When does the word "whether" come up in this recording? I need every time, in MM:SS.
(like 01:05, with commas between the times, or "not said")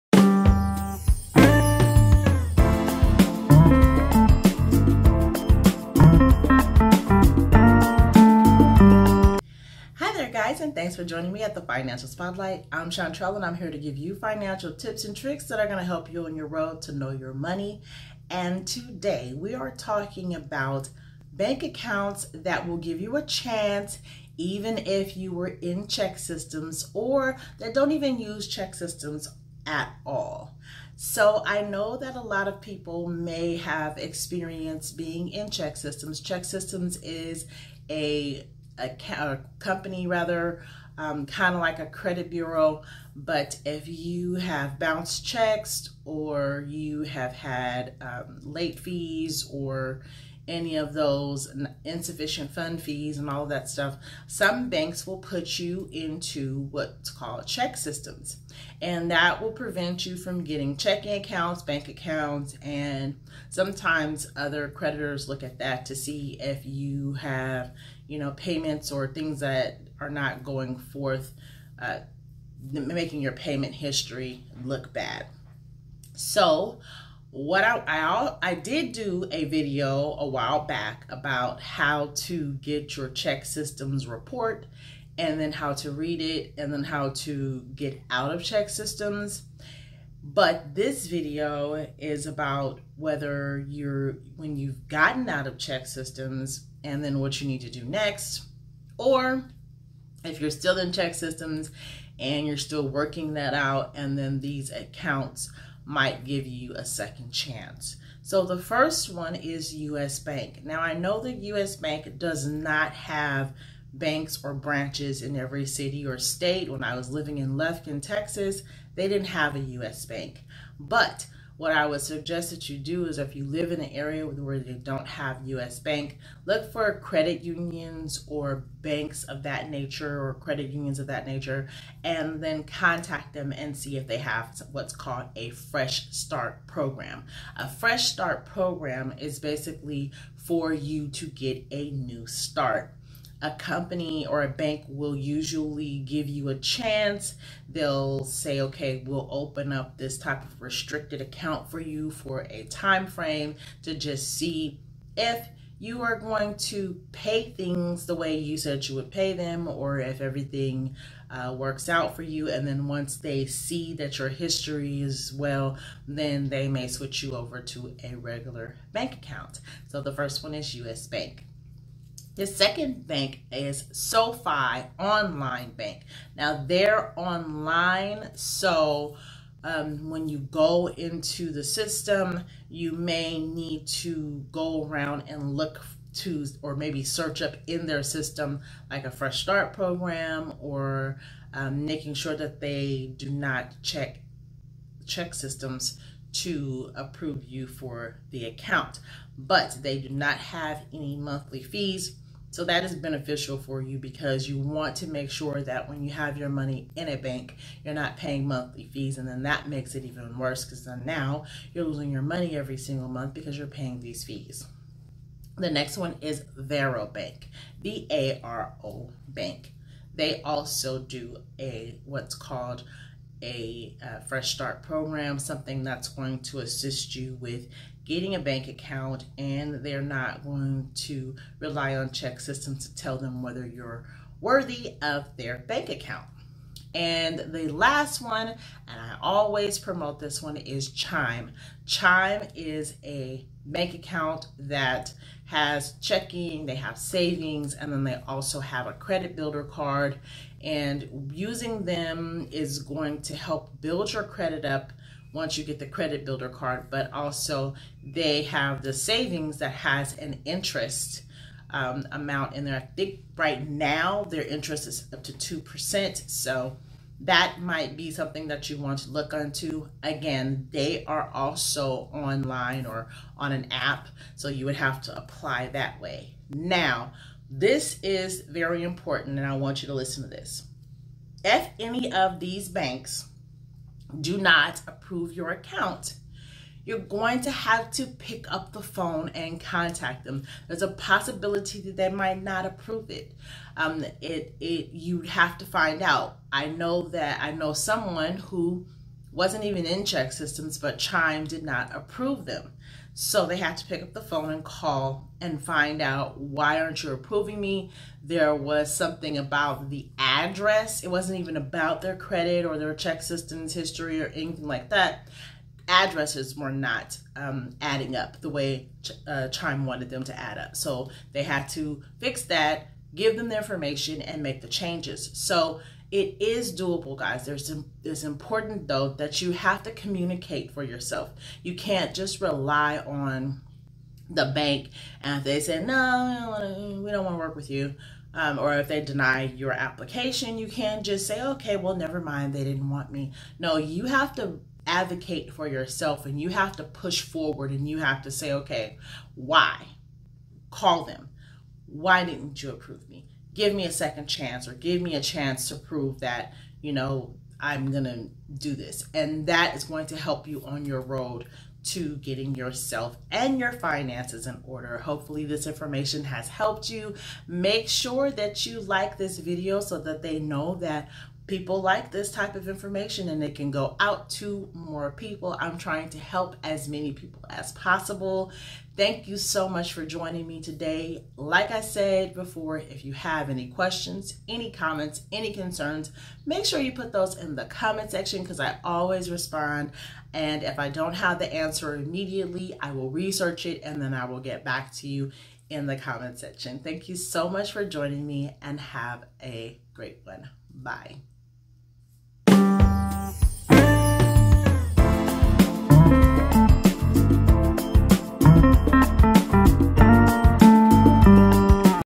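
01:32, 03:53.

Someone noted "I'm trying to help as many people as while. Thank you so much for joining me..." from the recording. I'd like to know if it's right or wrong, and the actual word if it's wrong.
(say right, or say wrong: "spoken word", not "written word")
wrong: "possible", not "while".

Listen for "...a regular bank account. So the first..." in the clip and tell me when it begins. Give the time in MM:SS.
02:48.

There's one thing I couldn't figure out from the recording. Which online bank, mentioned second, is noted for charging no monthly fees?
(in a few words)
SoFi.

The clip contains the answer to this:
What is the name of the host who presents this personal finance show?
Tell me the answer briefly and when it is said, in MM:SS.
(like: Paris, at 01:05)
Shantrell, at 00:12.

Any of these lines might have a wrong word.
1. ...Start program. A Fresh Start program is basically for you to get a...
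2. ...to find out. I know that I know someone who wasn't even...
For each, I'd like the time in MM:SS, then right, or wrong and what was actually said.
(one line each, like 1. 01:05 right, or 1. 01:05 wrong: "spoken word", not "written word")
1. 02:16 right
2. 04:55 right.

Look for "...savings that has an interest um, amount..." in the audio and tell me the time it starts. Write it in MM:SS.
04:18.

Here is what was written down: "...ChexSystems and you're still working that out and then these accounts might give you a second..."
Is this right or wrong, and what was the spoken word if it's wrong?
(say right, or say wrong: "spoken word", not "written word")
right.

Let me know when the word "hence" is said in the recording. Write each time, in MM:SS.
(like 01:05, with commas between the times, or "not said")
not said.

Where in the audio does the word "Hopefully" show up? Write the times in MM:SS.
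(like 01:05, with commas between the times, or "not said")
06:04.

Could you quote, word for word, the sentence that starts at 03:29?
And then that makes it even worse because then now you're losing your money every single month because you're paying these fees.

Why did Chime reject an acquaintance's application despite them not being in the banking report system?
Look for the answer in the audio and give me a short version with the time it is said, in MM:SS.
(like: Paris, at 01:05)
The address, at 05:09.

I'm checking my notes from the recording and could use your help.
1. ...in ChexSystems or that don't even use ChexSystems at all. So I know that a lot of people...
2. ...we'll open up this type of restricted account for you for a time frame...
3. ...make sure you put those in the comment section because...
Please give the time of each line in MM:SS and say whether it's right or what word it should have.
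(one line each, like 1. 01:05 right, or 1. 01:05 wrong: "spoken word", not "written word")
1. 00:25 right
2. 02:29 right
3. 06:26 right.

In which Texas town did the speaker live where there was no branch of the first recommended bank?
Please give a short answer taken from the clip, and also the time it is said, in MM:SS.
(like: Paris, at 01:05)
Lufkin, at 01:57.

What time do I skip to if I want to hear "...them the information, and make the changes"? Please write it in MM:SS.
05:23.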